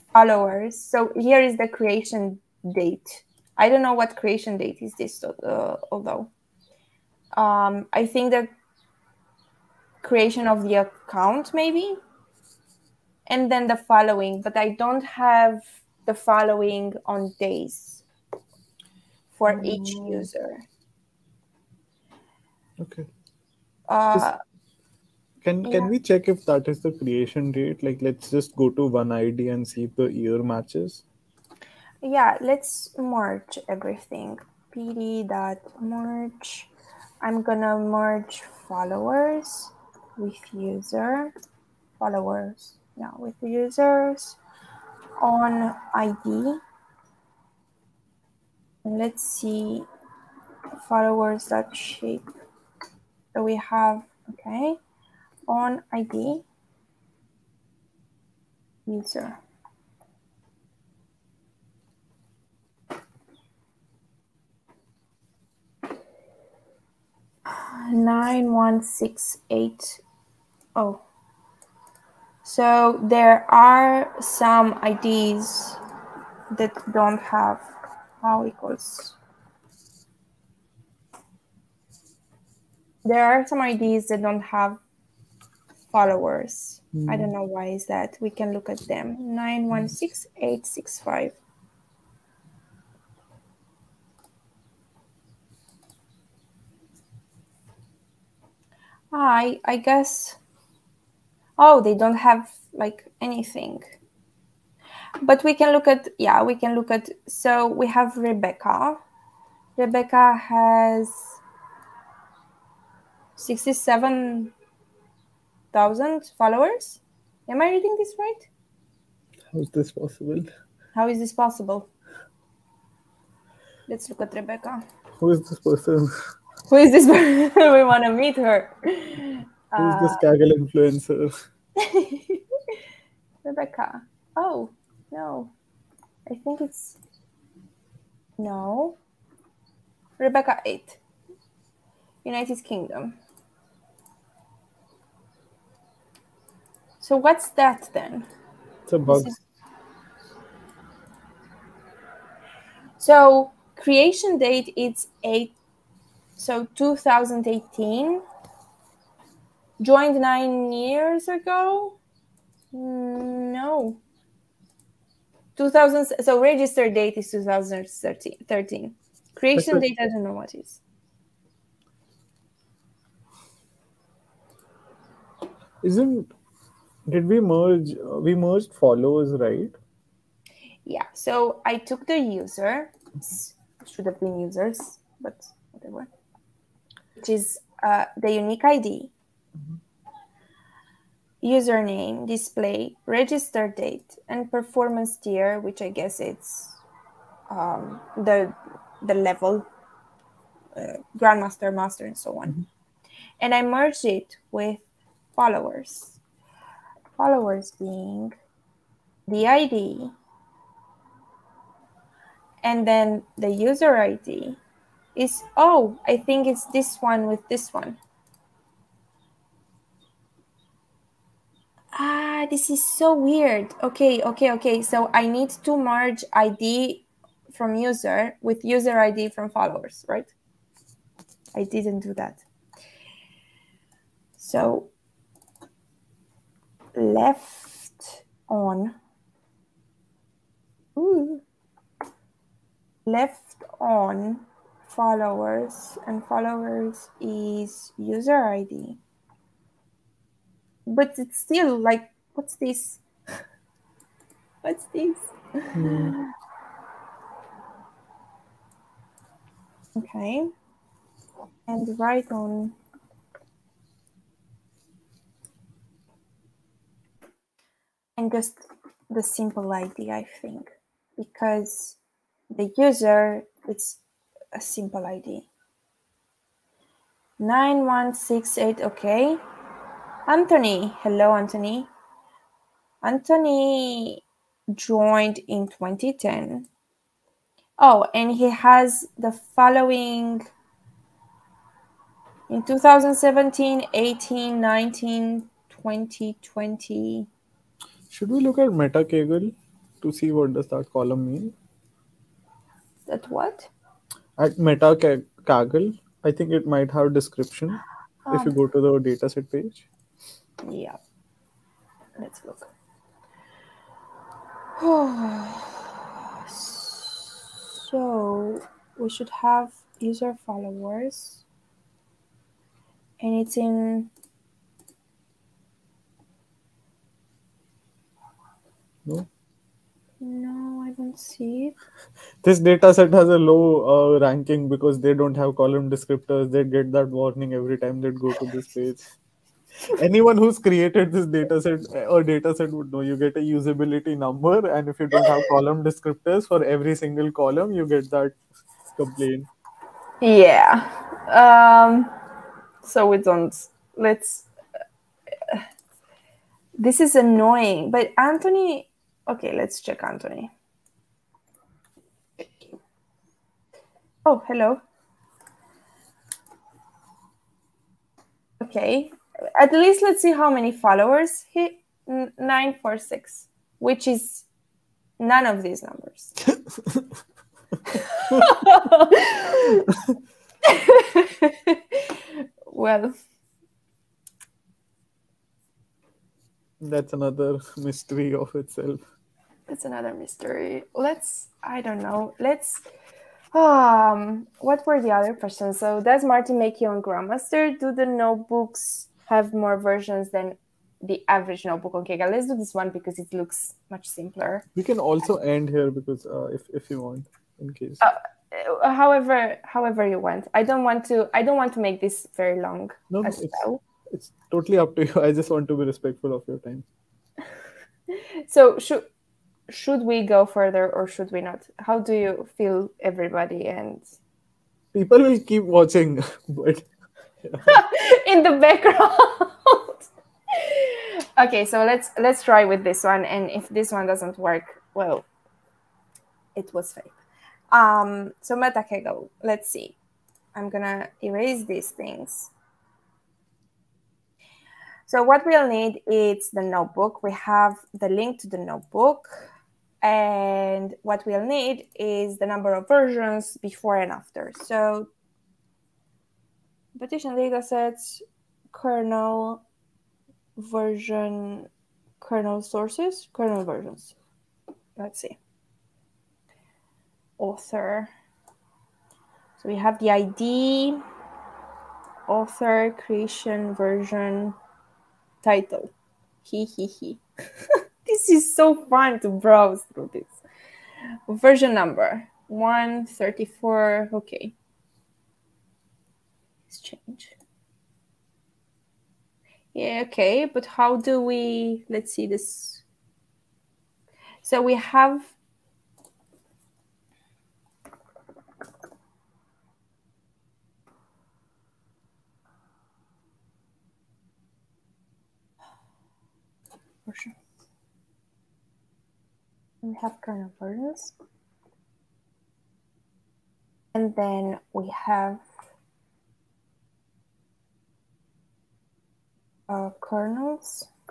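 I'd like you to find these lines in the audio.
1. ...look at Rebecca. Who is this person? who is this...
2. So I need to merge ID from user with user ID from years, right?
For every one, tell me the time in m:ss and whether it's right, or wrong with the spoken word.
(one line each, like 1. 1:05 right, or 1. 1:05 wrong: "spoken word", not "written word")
1. 2:04 right
2. 3:44 wrong: "followers", not "years".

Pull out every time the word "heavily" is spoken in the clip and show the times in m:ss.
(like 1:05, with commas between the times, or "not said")
not said.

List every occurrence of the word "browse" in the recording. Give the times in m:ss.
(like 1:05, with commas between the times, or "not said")
7:59.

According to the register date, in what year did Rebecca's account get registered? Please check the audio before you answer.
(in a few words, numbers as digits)
2013.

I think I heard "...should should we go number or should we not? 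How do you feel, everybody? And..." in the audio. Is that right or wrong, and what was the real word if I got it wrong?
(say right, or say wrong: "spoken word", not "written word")
wrong: "further", not "number".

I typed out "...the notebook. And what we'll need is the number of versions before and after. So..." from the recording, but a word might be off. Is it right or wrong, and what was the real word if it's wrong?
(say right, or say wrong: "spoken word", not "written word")
right.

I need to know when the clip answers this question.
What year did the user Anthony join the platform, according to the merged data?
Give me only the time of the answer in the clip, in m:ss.
4:45.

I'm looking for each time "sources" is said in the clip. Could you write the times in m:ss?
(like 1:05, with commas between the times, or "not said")
7:42.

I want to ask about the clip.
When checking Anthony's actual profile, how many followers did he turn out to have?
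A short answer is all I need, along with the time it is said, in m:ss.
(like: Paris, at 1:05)
946, at 6:12.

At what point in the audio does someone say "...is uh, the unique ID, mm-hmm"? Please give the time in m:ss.
3:07.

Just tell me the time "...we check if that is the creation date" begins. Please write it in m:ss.
0:25.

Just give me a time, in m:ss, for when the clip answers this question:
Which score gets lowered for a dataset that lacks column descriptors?
5:43.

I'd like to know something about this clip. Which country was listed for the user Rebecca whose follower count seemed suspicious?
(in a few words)
United Kingdom.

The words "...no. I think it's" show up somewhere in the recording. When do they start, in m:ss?
2:15.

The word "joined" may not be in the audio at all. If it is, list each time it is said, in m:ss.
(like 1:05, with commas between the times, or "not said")
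2:39, 4:44.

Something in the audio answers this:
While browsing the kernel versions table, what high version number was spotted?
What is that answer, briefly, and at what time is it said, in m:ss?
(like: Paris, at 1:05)
134, at 8:02.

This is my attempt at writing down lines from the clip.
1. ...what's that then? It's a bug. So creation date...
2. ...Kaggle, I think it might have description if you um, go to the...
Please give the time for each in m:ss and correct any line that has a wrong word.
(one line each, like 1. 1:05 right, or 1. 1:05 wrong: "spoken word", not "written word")
1. 2:27 right
2. 5:05 right.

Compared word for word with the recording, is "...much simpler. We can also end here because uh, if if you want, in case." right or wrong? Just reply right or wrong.
right.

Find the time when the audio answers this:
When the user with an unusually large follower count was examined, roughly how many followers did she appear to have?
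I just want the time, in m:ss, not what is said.
1:53.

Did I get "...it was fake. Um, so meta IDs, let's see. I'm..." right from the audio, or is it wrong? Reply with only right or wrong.
wrong.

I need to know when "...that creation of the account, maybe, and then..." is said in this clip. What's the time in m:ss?
0:08.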